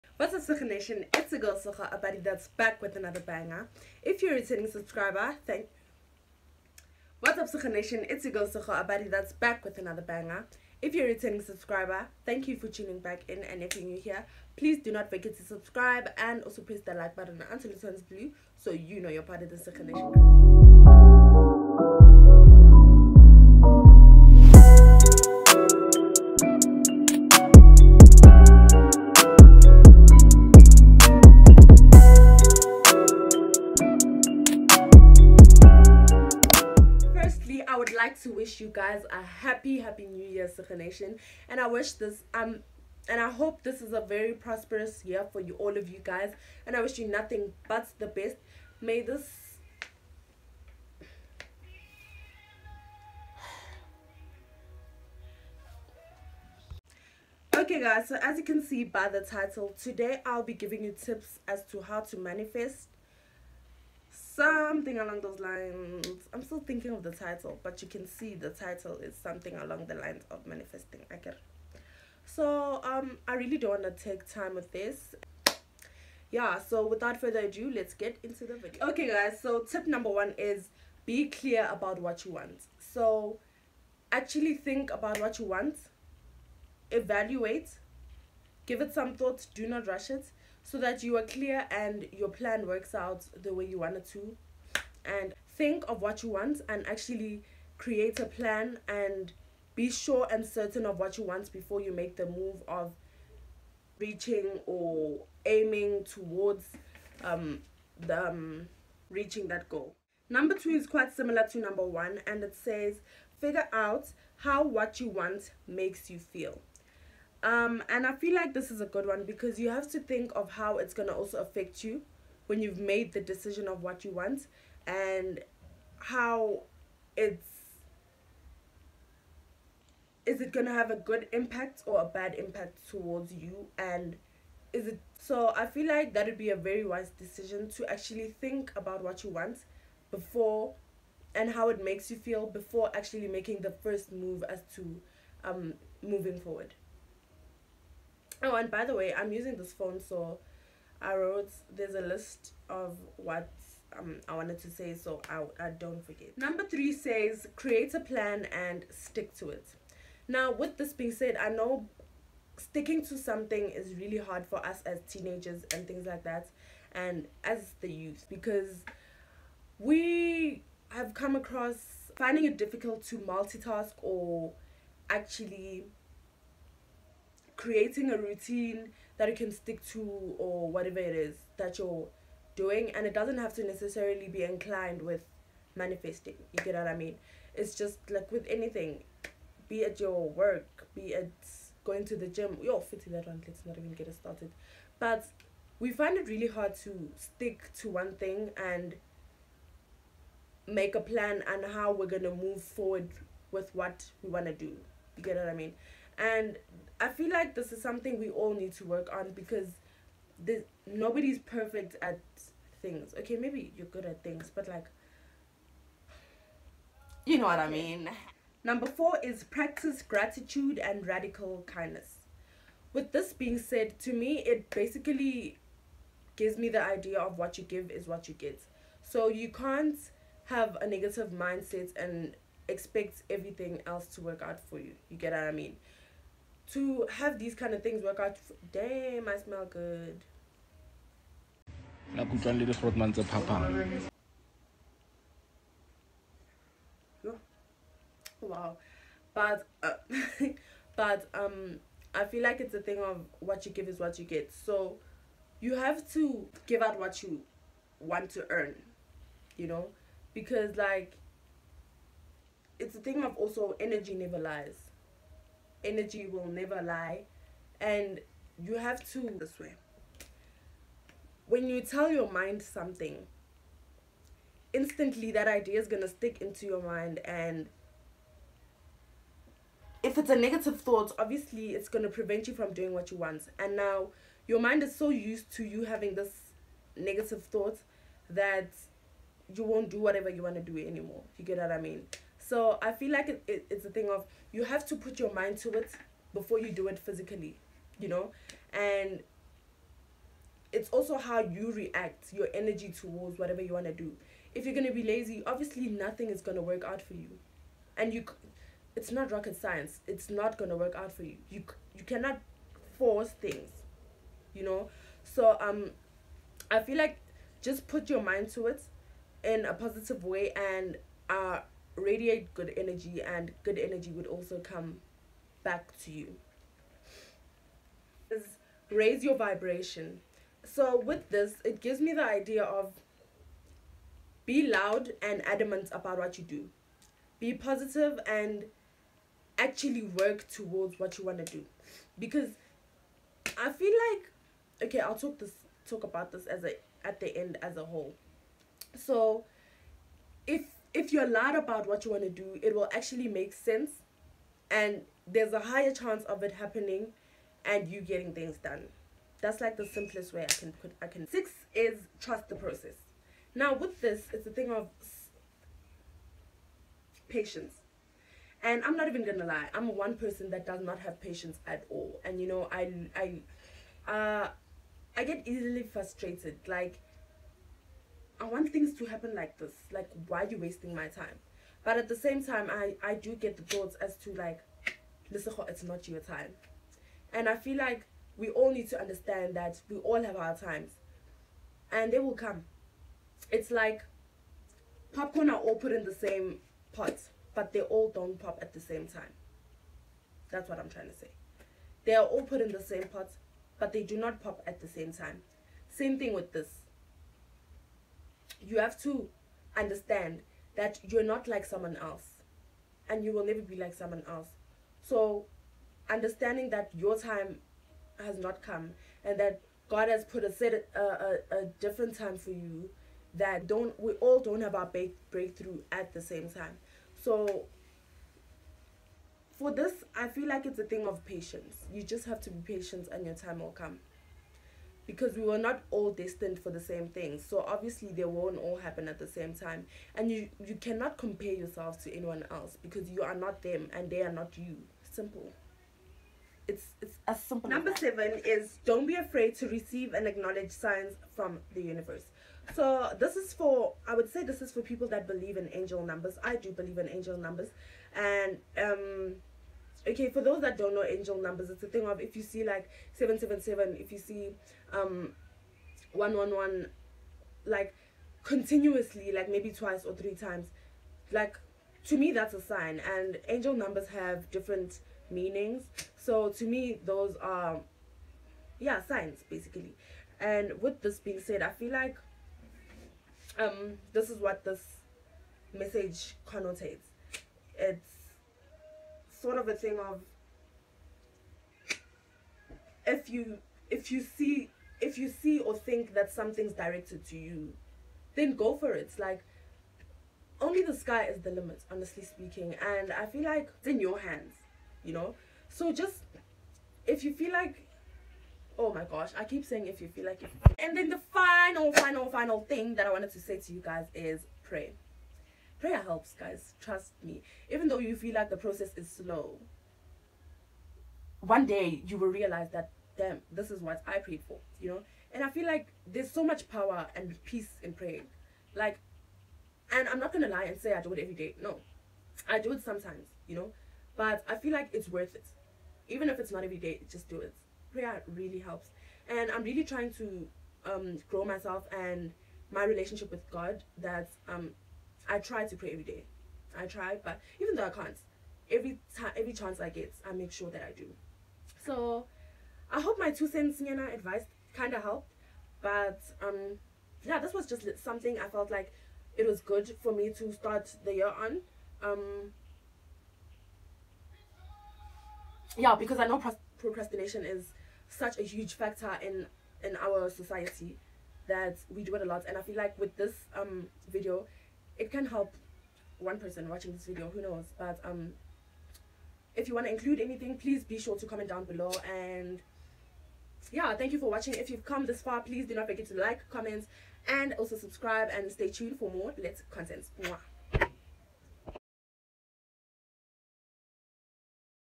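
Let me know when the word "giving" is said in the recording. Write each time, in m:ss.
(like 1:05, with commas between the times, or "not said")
1:00.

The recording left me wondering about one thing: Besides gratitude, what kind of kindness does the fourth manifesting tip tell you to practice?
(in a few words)
radical kindness.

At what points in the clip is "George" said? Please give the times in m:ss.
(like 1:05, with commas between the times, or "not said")
not said.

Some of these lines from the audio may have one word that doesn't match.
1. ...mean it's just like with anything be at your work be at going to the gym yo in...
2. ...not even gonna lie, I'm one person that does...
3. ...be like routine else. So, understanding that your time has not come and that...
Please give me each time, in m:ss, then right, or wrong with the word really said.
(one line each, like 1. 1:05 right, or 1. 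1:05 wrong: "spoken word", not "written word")
1. 3:06 right
2. 6:08 right
3. 6:53 wrong: "someone", not "routine".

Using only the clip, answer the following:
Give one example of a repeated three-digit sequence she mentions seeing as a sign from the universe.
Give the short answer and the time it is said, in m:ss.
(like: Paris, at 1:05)
777, at 7:43.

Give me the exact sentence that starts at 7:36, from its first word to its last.
I do believe in angel numbers.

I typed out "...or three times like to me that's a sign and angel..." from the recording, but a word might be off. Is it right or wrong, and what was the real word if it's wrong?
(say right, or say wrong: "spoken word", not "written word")
right.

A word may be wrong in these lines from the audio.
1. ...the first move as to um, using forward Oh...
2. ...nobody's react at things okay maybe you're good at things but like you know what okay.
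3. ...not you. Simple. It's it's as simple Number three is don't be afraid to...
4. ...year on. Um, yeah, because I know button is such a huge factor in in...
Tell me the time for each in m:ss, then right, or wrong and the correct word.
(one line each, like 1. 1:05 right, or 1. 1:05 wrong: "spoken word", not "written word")
1. 2:23 wrong: "moving", not "using"
2. 3:30 wrong: "perfect", not "react"
3. 7:24 wrong: "seven", not "three"
4. 9:21 wrong: "procrastination", not "button".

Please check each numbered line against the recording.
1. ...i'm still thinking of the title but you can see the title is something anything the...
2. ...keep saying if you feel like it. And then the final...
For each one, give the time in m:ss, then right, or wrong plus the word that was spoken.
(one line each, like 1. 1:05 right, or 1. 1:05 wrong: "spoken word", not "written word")
1. 1:06 wrong: "along", not "anything"
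2. 8:29 right.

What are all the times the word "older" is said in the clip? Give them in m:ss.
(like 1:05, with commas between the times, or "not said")
not said.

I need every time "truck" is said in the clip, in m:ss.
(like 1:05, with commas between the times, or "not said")
not said.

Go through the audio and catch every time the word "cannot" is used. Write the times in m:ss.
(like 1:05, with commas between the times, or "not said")
5:12, 7:20.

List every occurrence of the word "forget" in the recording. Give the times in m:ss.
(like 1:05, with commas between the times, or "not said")
0:15, 2:36, 9:45.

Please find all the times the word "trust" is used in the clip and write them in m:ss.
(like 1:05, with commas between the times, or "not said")
6:02, 8:36.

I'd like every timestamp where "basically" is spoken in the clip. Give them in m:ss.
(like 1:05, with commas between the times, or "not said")
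3:44, 7:59.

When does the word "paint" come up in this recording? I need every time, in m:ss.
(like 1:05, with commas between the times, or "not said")
not said.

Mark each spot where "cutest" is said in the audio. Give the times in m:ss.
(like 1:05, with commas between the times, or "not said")
not said.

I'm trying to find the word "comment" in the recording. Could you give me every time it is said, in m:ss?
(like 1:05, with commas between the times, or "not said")
9:41, 9:46.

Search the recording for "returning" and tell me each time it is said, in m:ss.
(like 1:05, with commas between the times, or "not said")
0:04, 0:11.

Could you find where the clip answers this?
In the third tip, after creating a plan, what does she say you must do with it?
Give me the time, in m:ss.
2:38.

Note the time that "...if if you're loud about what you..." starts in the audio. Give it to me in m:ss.
5:50.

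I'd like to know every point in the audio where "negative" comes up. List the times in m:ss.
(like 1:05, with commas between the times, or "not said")
3:50, 4:40, 4:46.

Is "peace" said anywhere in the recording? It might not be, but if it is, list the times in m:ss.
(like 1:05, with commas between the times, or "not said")
8:47.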